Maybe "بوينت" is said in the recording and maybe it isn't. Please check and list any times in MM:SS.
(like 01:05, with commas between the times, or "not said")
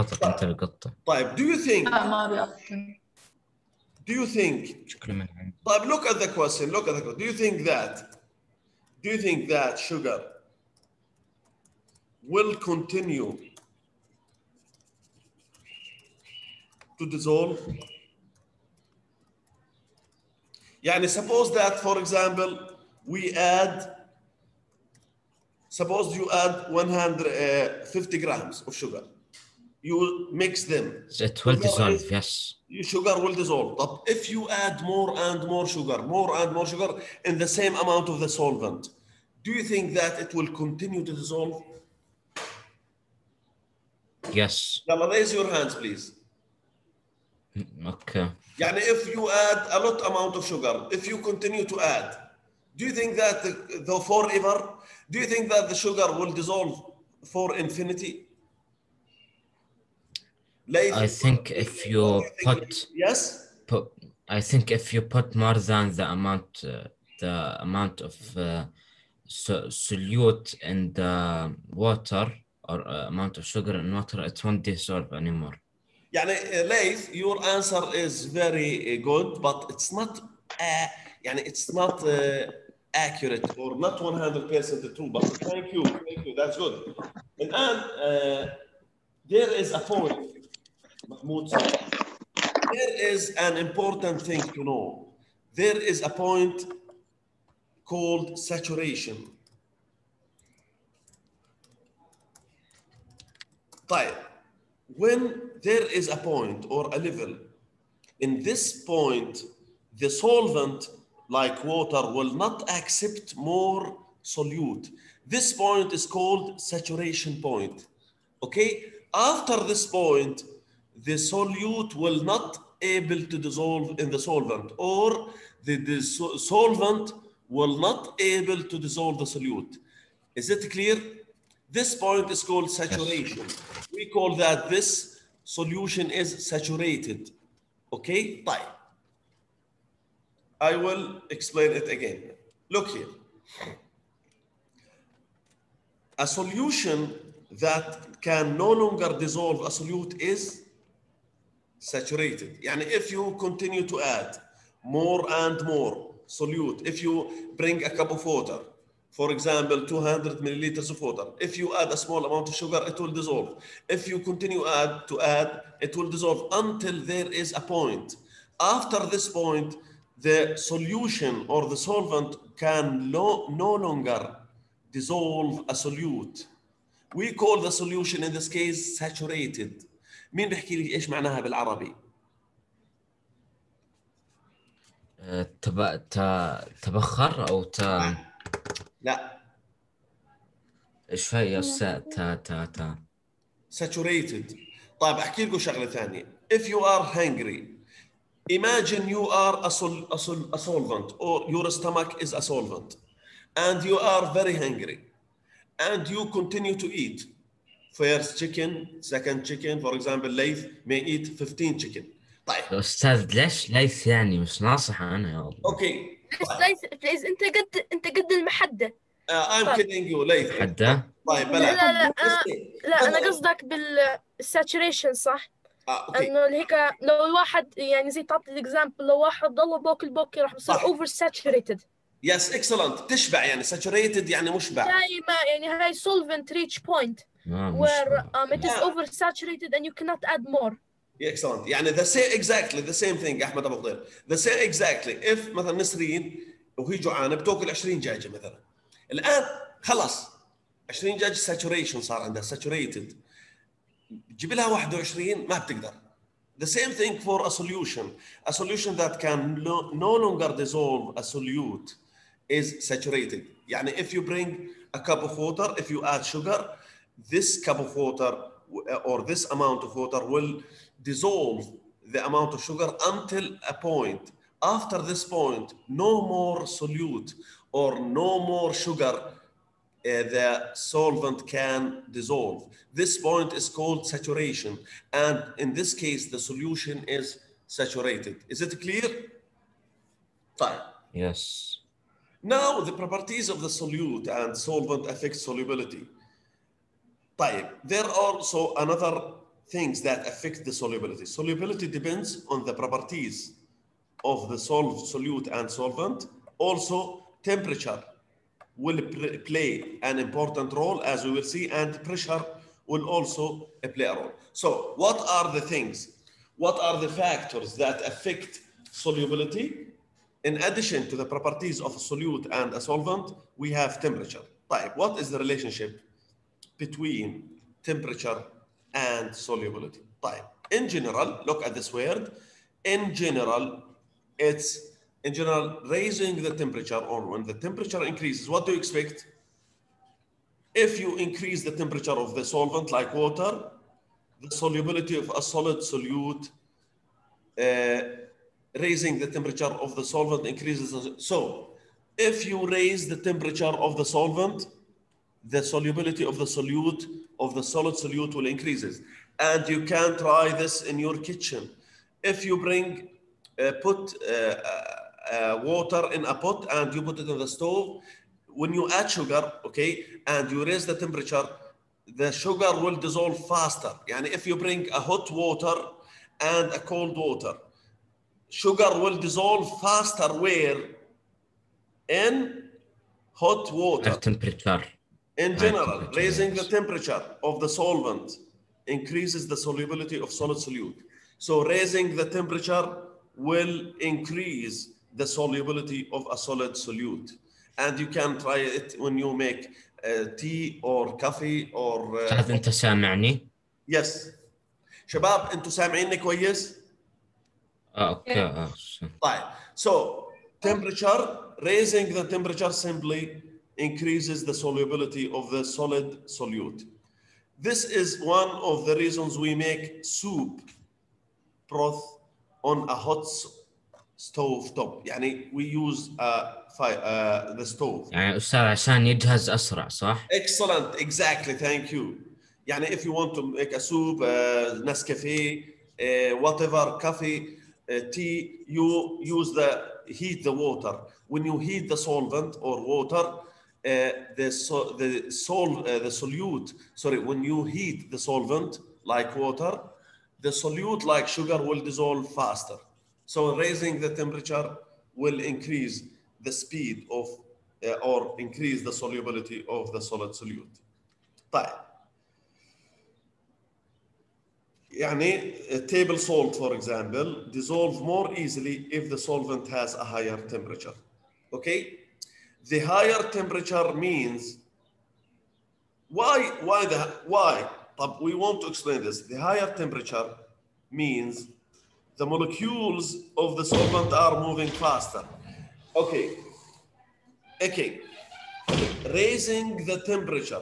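03:56.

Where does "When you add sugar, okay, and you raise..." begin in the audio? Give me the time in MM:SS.
06:08.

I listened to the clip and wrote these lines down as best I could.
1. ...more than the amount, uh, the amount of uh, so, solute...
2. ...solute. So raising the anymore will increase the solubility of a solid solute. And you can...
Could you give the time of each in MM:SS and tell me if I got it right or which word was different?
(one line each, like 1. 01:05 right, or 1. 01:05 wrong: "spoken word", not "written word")
1. 01:05 right
2. 06:30 wrong: "temperature", not "anymore".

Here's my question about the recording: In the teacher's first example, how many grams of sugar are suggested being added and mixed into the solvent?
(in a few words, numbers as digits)
150.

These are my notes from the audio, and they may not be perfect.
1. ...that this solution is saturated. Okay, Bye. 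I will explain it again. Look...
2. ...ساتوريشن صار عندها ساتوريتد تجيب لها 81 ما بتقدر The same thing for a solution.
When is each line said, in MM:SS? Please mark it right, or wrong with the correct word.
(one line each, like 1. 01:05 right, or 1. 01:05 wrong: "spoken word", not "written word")
1. 02:14 right
2. 04:11 wrong: "21", not "81".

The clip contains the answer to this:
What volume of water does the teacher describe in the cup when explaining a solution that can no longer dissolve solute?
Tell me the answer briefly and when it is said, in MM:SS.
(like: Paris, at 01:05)
200 milliliters, at 02:39.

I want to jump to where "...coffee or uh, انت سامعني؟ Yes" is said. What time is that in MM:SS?
06:41.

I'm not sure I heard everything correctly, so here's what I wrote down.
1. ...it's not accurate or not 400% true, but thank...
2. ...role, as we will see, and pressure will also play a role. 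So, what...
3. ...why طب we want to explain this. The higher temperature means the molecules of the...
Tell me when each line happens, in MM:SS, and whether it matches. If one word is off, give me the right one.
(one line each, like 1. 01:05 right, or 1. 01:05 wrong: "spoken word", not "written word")
1. 01:21 wrong: "100", not "400"
2. 05:10 right
3. 07:57 right.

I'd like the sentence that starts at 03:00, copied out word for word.
مين بيحكي لي ايش معناها بالعربي؟ تب...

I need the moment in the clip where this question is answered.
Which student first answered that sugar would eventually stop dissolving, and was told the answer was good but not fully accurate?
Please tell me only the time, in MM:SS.
01:16.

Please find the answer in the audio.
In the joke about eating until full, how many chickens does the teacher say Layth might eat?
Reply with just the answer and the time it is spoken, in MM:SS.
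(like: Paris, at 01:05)
15, at 03:31.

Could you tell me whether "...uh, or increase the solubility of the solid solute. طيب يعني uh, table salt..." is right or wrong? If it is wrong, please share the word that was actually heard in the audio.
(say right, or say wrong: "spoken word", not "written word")
right.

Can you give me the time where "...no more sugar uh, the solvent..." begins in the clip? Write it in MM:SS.
04:37.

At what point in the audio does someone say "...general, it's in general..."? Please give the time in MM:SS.
05:33.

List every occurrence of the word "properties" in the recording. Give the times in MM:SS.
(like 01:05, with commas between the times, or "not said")
04:52, 05:02, 05:21.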